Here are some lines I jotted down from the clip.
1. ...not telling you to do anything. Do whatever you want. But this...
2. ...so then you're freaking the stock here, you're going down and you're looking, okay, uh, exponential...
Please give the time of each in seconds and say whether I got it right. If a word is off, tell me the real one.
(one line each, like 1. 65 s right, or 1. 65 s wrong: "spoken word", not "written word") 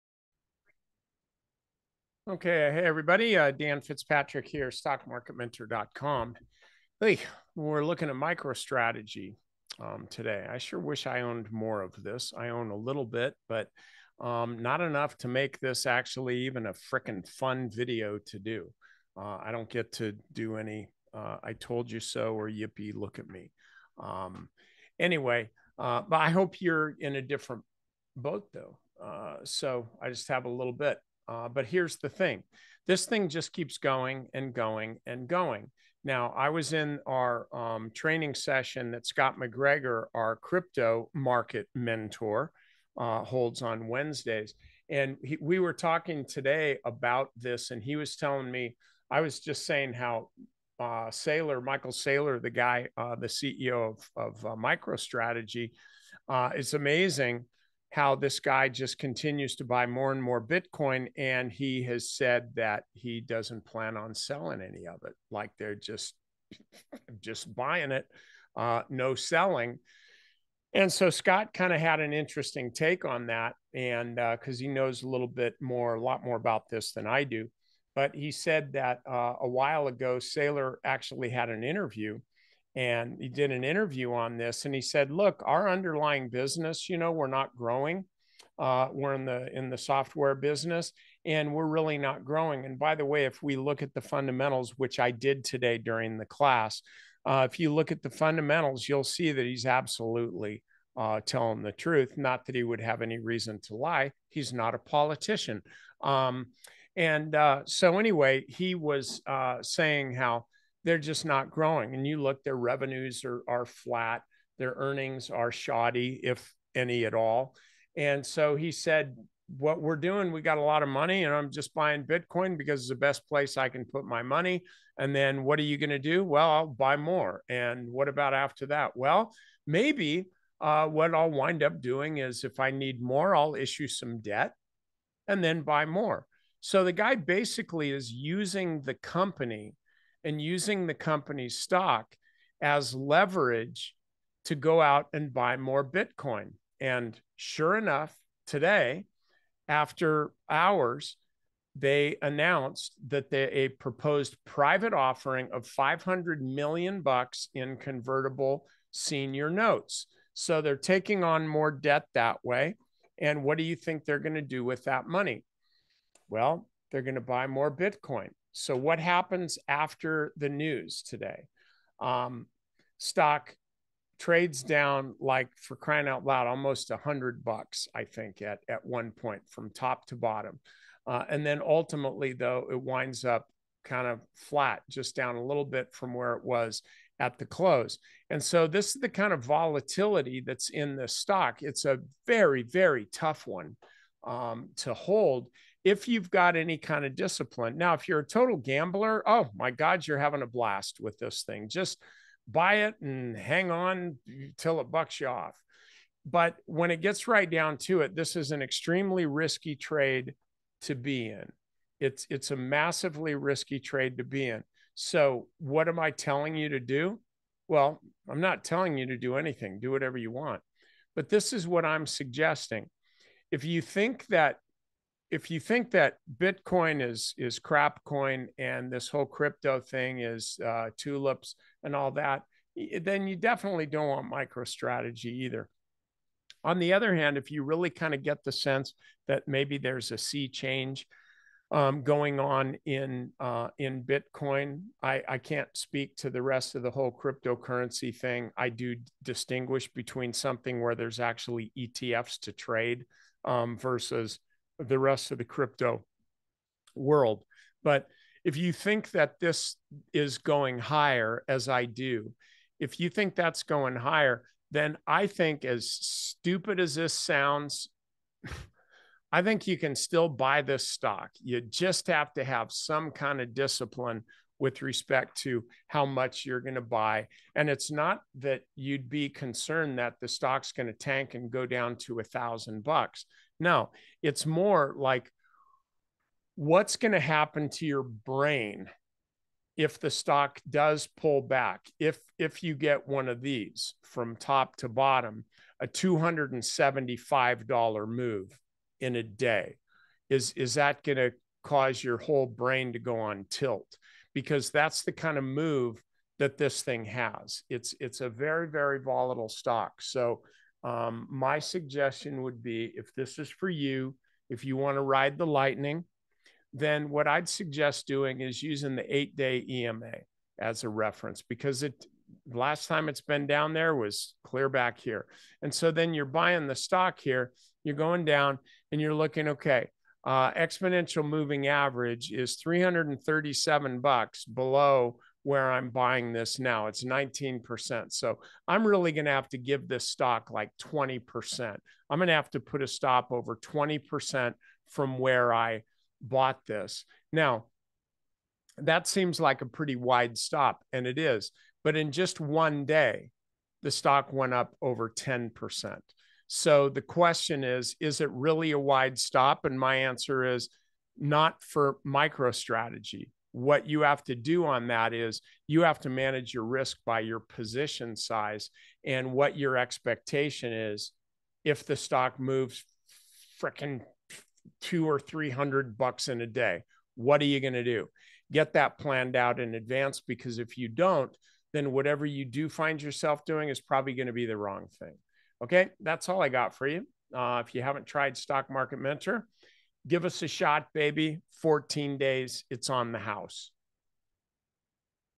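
1. 218 s right
2. 325 s wrong: "buying", not "freaking".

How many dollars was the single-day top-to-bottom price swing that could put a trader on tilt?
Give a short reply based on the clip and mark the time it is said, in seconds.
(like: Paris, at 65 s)
$275, at 295 s.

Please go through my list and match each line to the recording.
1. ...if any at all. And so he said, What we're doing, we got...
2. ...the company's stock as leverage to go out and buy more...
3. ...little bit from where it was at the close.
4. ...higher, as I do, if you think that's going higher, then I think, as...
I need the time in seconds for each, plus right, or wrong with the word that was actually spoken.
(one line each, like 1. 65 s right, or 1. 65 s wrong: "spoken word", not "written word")
1. 116 s right
2. 140 s right
3. 185 s right
4. 260 s right.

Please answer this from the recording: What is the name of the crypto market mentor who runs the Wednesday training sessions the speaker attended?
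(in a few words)
Scott McGregor.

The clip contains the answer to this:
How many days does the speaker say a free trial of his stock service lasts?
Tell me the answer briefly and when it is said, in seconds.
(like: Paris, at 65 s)
14 days, at 391 s.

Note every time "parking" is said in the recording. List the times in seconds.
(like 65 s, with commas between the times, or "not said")
not said.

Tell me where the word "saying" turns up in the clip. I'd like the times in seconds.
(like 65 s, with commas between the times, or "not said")
49 s, 109 s.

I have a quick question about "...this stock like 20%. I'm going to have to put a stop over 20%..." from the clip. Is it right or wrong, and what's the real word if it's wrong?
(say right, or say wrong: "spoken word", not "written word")
right.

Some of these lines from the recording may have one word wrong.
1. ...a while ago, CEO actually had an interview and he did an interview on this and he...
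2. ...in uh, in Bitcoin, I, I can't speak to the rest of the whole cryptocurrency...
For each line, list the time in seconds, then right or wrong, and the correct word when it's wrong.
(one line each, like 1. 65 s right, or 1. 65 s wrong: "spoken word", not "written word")
1. 79 s wrong: "Saylor", not "CEO"
2. 242 s right.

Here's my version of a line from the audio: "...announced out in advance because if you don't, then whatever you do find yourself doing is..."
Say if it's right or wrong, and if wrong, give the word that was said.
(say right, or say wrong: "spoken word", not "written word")
wrong: "planned", not "announced".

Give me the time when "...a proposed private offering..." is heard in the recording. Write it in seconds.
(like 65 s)
153 s.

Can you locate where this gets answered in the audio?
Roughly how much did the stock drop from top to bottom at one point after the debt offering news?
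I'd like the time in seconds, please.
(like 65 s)
176 s.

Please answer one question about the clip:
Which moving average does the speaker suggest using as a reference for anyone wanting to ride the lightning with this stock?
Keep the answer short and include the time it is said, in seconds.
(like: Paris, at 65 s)
8 day EMA, at 319 s.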